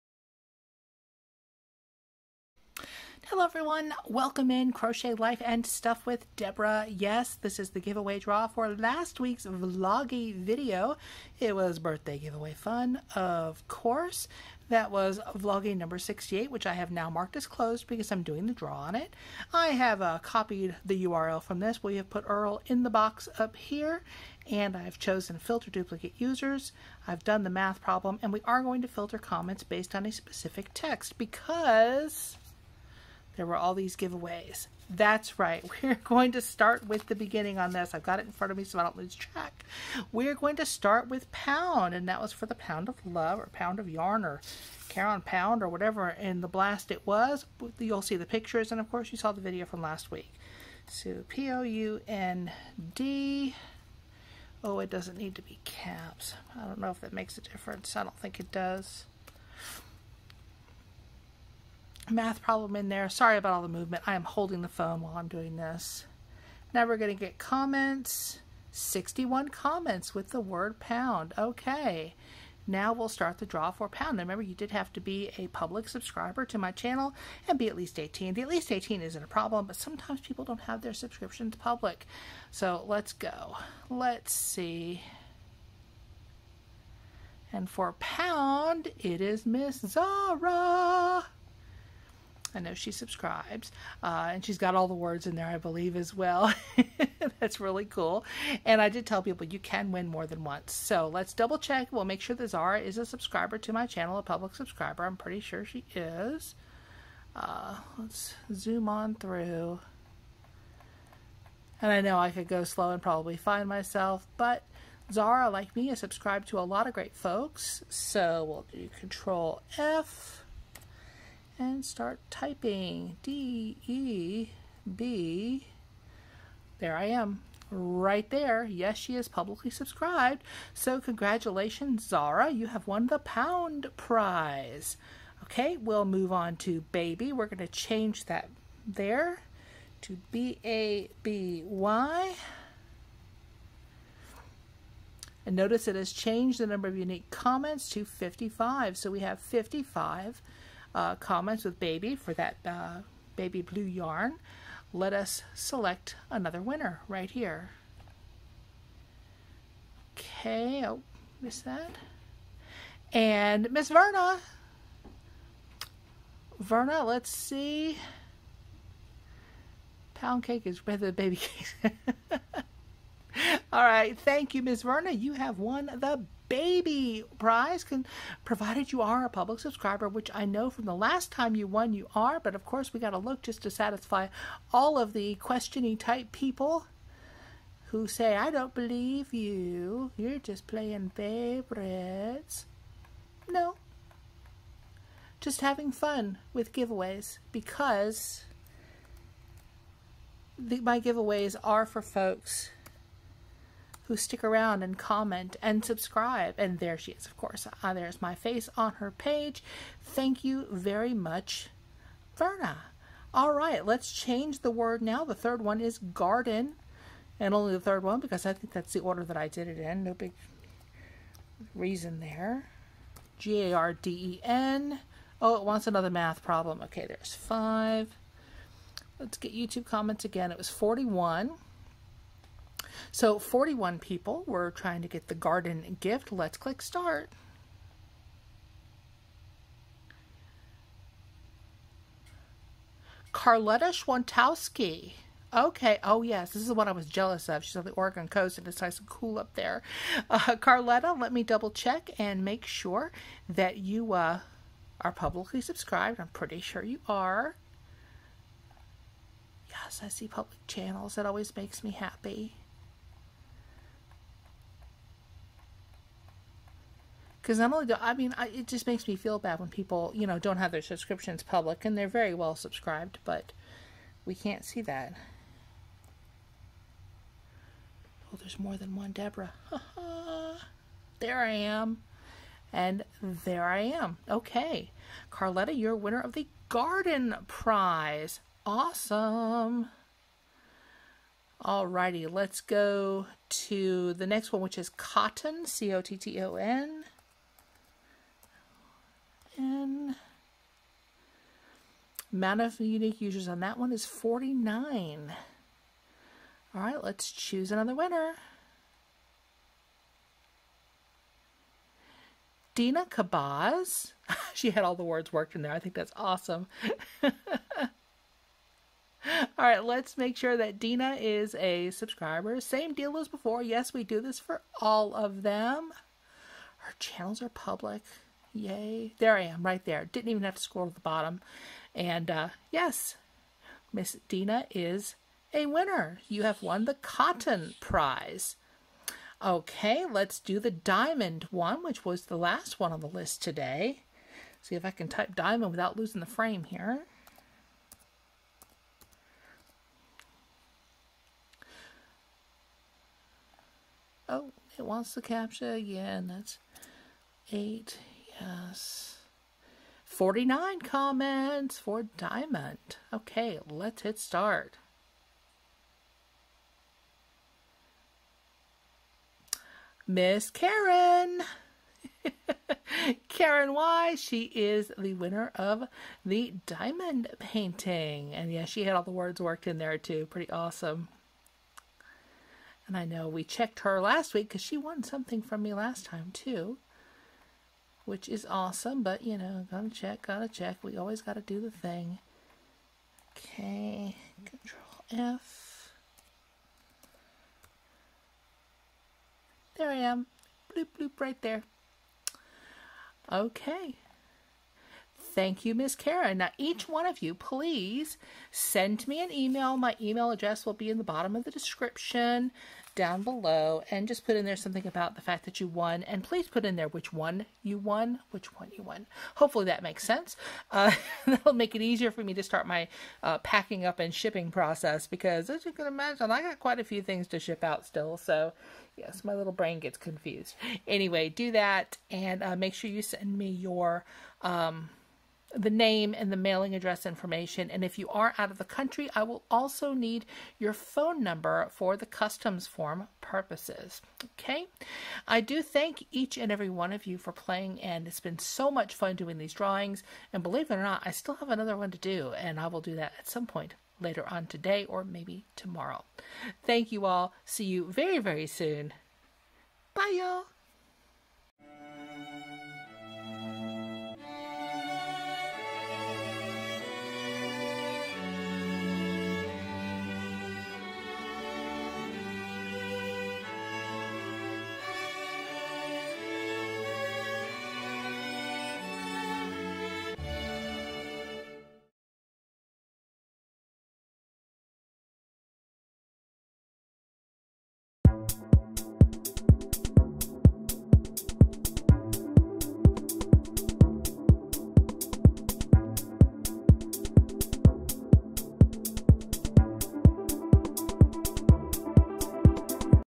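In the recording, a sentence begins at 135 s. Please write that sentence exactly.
Okay, we'll move on to baby.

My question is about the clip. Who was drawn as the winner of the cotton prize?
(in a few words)
Dina Kabaz.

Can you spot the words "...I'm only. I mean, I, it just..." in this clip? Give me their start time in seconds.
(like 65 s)
267 s.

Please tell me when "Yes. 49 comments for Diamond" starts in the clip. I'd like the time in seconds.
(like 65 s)
358 s.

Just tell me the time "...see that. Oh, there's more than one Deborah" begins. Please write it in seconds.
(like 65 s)
274 s.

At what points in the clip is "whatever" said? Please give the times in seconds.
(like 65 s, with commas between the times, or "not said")
45 s.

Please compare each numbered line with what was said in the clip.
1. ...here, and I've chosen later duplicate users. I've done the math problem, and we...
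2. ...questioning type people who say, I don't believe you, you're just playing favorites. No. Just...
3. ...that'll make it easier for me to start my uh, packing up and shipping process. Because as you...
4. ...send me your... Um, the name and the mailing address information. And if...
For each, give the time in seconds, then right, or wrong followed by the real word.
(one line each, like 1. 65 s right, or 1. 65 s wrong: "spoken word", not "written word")
1. 23 s wrong: "filter", not "later"
2. 185 s right
3. 421 s right
4. 433 s right.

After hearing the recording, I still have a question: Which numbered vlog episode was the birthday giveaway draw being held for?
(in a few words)
68.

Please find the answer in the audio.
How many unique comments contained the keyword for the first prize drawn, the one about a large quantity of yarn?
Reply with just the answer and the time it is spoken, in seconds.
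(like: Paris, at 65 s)
61, at 68 s.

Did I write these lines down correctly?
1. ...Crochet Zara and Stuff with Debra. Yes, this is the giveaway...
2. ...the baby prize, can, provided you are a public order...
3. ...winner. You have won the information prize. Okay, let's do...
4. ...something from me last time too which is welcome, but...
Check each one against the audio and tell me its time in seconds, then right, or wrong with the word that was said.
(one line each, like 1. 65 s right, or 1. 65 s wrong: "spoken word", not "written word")
1. 4 s wrong: "Life", not "Zara"
2. 175 s wrong: "subscriber", not "order"
3. 335 s wrong: "cotton", not "information"
4. 385 s wrong: "awesome", not "welcome".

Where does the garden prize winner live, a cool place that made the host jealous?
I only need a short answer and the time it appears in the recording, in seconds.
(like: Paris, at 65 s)
Oregon coast, at 247 s.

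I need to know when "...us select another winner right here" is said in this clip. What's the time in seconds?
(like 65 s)
155 s.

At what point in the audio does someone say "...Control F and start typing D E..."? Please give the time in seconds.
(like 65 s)
118 s.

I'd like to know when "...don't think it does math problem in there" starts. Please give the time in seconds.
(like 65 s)
58 s.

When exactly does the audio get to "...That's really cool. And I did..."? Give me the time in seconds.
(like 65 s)
97 s.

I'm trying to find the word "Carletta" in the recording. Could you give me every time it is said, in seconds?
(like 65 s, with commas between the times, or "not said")
243 s, 250 s, 285 s.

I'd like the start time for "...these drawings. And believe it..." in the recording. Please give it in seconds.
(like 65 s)
449 s.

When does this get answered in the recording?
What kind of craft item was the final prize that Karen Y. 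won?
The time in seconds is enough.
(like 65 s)
376 s.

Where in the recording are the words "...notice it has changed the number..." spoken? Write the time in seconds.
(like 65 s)
145 s.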